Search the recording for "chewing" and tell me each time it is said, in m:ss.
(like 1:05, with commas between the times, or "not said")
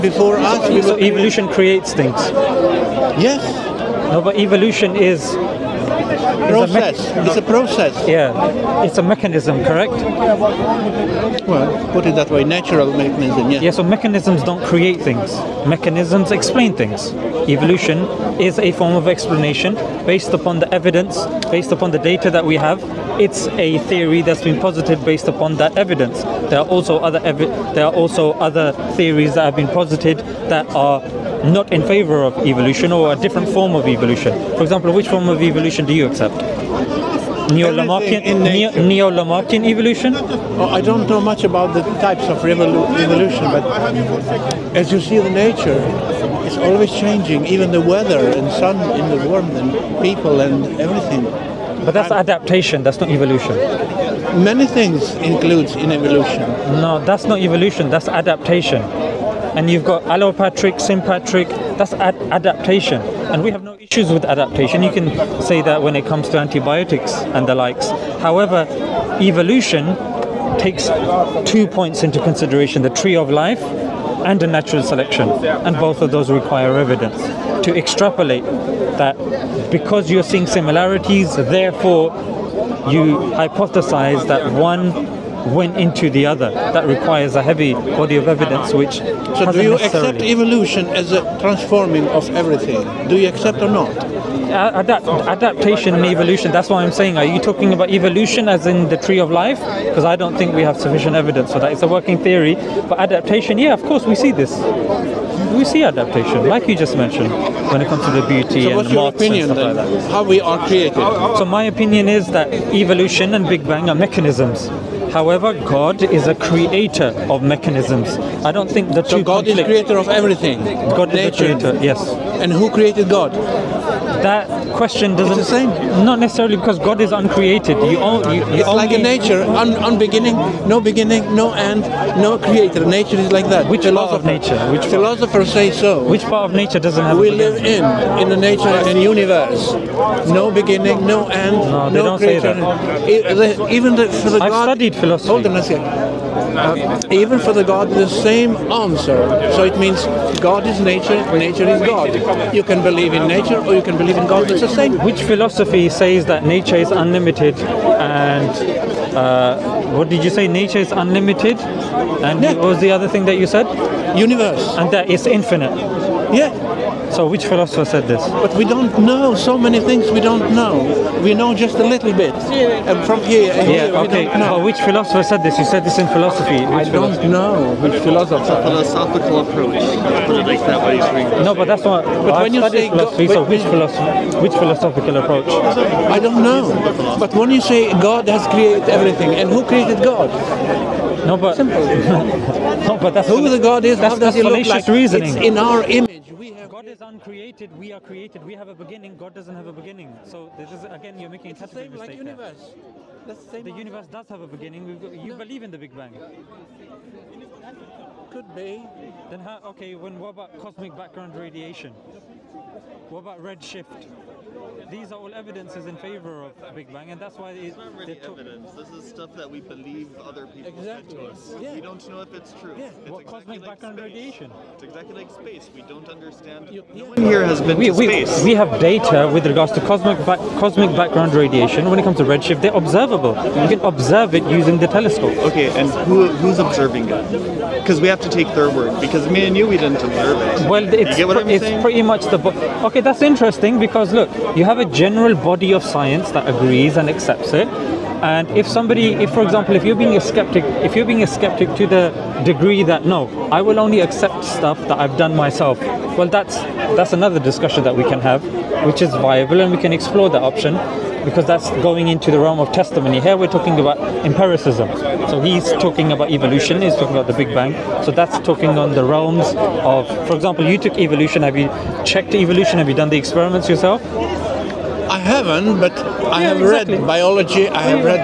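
not said.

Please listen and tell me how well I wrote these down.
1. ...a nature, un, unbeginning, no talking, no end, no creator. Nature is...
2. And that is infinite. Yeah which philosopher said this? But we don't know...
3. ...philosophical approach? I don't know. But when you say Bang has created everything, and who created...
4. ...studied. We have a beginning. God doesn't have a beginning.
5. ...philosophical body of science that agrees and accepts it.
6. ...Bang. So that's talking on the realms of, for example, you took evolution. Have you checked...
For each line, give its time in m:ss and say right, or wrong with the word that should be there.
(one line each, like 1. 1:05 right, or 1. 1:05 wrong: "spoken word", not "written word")
1. 2:08 wrong: "beginning", not "talking"
2. 2:44 right
3. 3:04 wrong: "God", not "Bang"
4. 3:18 wrong: "created", not "studied"
5. 4:04 wrong: "general", not "philosophical"
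6. 4:27 right.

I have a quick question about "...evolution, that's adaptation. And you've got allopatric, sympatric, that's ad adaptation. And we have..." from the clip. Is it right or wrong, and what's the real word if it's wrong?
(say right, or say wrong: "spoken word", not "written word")
right.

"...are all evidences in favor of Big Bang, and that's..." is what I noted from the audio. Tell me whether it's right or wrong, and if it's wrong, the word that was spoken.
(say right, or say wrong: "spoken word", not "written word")
right.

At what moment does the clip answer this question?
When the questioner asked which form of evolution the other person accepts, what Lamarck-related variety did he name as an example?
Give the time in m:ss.
0:37.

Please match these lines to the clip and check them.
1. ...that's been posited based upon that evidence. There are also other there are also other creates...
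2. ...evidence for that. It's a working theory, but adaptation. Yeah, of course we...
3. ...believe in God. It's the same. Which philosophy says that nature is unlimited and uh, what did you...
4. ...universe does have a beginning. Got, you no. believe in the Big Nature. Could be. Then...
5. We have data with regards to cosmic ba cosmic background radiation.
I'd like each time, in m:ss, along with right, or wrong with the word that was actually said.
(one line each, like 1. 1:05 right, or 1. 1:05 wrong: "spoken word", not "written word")
1. 0:24 wrong: "theories", not "creates"
2. 1:41 right
3. 2:33 right
4. 3:23 wrong: "Bang", not "Nature"
5. 3:48 right.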